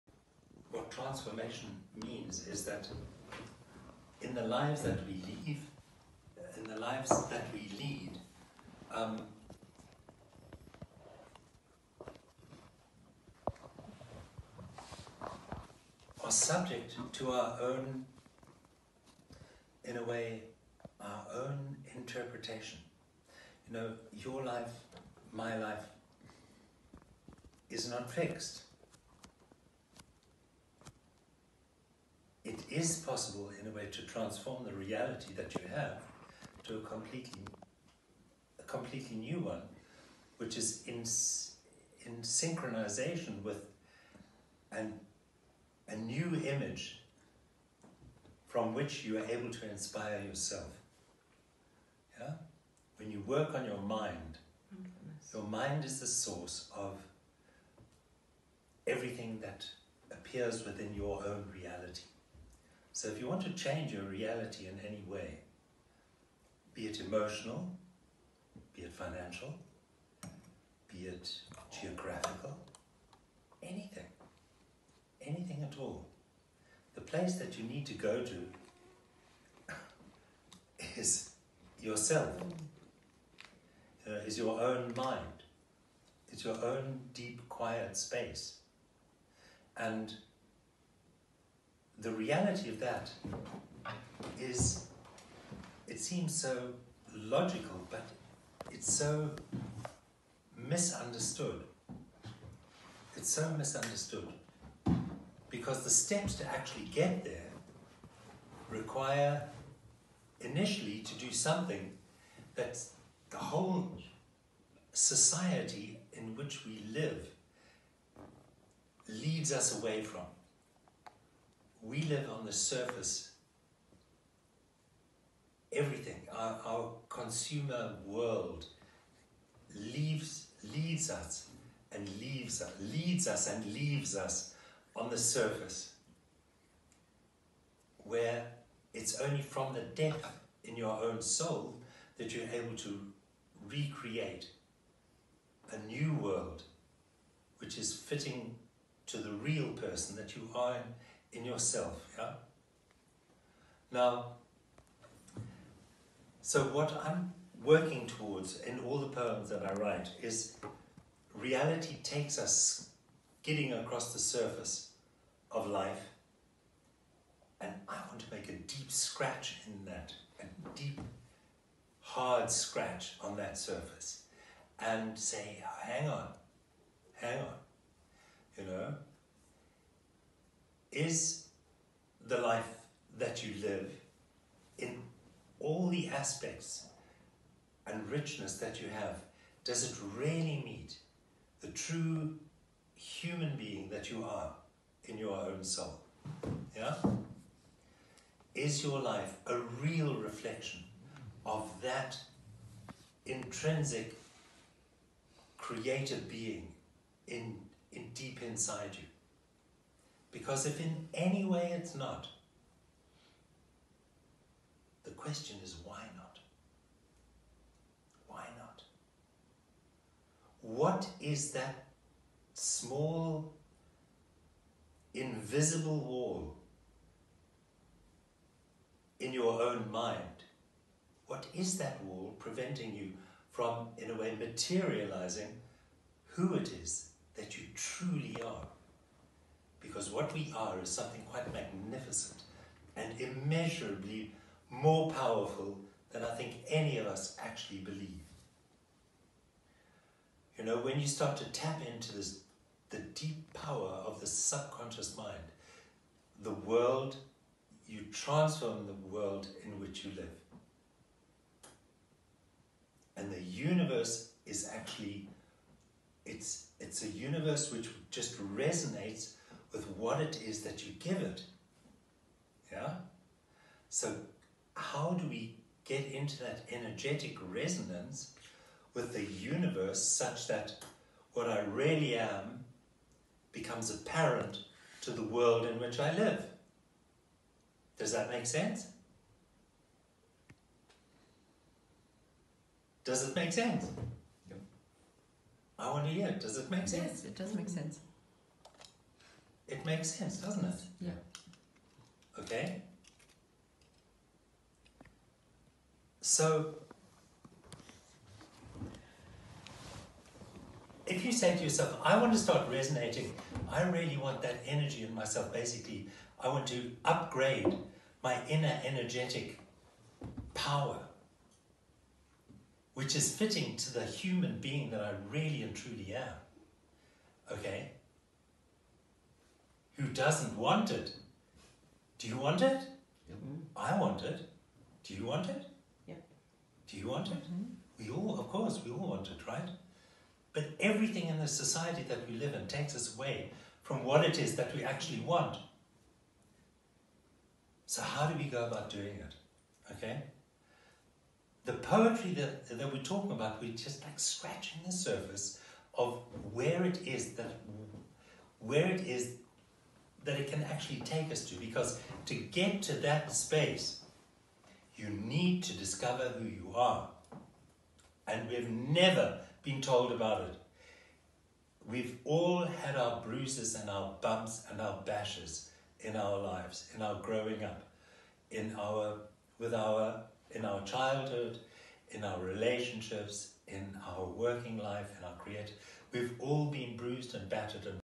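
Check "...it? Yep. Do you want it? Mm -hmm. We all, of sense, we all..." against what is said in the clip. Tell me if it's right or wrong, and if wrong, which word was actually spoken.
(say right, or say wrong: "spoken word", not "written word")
wrong: "course", not "sense".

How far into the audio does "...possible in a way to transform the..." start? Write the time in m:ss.
0:32.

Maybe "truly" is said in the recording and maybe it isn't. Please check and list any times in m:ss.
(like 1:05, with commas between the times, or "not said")
3:57, 5:25.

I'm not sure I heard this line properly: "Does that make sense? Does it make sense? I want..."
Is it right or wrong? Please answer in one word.
right.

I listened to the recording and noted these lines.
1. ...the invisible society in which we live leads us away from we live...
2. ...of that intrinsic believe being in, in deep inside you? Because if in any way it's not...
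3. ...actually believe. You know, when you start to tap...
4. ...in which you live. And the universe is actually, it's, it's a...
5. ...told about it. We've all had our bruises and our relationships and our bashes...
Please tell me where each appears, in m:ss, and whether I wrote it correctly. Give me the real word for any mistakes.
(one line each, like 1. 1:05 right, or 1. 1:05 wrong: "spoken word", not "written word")
1. 1:53 wrong: "whole", not "invisible"
2. 3:21 wrong: "creative", not "believe"
3. 4:07 right
4. 4:19 right
5. 6:09 wrong: "bumps", not "relationships".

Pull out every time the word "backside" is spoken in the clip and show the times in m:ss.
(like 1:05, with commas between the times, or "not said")
not said.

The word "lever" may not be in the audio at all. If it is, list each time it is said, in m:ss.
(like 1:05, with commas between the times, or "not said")
not said.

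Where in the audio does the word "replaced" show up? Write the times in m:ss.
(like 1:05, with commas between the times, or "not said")
not said.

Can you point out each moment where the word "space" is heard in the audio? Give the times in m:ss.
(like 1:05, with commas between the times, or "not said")
1:27, 6:03.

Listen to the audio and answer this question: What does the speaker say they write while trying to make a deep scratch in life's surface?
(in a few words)
Poems.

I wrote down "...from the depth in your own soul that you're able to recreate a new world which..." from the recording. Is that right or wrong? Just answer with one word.
right.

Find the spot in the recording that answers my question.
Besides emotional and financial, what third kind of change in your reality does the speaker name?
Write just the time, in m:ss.
1:11.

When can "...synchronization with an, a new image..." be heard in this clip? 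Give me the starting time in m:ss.
0:42.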